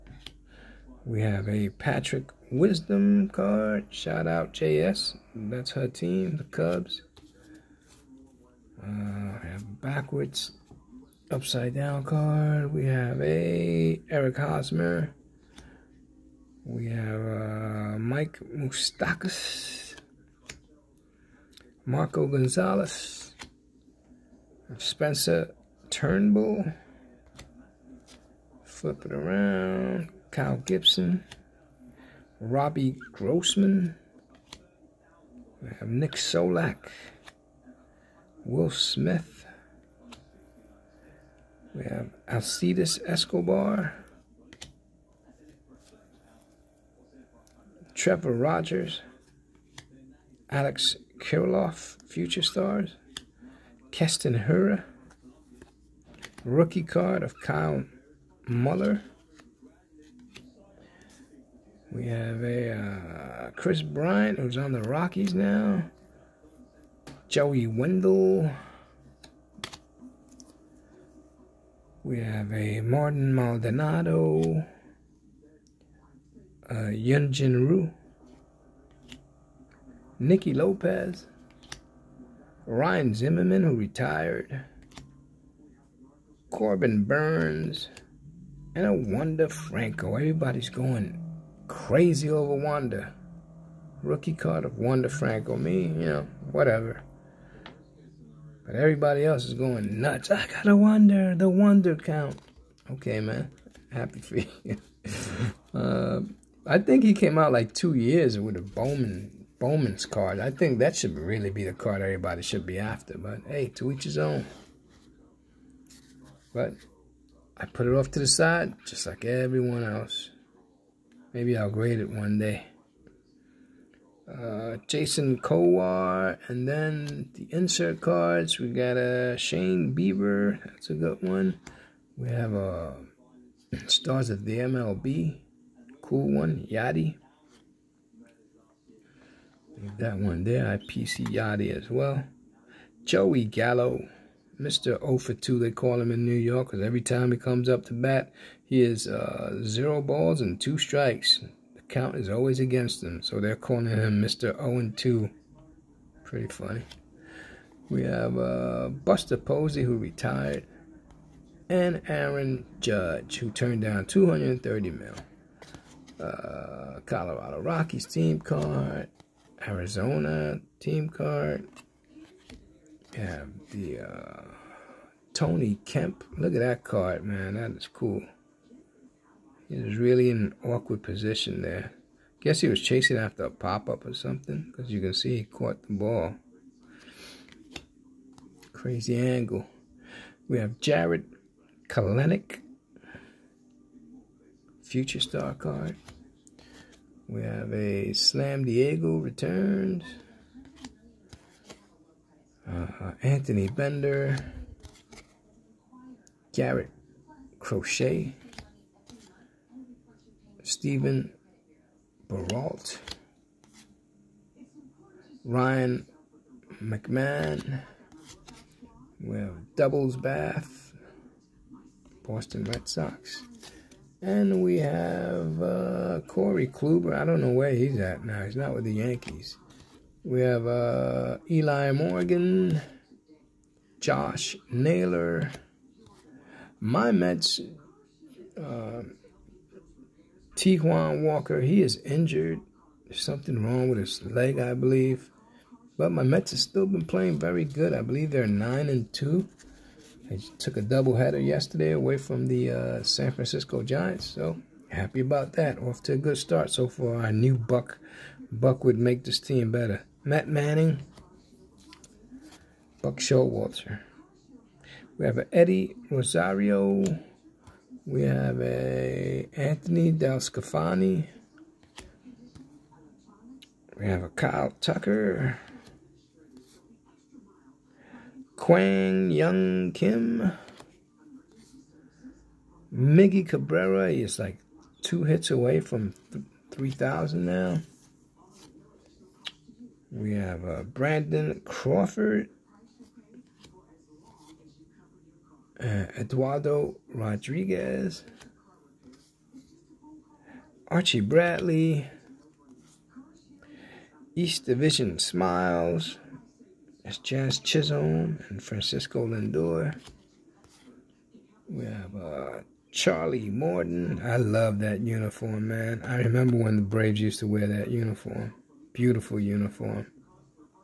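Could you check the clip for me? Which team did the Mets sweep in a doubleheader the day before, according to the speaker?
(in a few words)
San Francisco Giants.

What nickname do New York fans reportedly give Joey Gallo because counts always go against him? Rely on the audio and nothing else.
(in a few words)
Mr. 0 for 2.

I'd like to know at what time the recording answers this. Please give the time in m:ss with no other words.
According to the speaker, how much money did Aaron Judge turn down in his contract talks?
2:44.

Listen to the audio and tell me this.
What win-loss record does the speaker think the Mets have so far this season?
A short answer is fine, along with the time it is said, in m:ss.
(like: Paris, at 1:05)
9 and 2, at 4:08.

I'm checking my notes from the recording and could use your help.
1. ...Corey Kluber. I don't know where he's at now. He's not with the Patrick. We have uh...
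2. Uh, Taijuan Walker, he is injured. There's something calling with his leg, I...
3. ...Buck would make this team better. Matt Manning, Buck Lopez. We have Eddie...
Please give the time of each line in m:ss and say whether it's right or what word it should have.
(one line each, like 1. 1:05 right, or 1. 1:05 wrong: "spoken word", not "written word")
1. 3:46 wrong: "Yankees", not "Patrick"
2. 3:58 wrong: "wrong", not "calling"
3. 4:18 wrong: "Showalter", not "Lopez".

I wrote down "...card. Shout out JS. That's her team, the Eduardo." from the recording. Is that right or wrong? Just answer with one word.
wrong.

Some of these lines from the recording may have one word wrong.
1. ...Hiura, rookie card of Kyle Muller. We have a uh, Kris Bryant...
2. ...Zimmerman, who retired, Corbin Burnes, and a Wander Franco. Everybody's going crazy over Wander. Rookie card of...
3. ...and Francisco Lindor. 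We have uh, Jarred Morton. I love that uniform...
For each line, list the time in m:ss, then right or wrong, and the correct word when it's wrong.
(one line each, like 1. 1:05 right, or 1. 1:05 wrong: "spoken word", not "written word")
1. 0:54 right
2. 1:23 right
3. 5:08 wrong: "Charlie", not "Jarred".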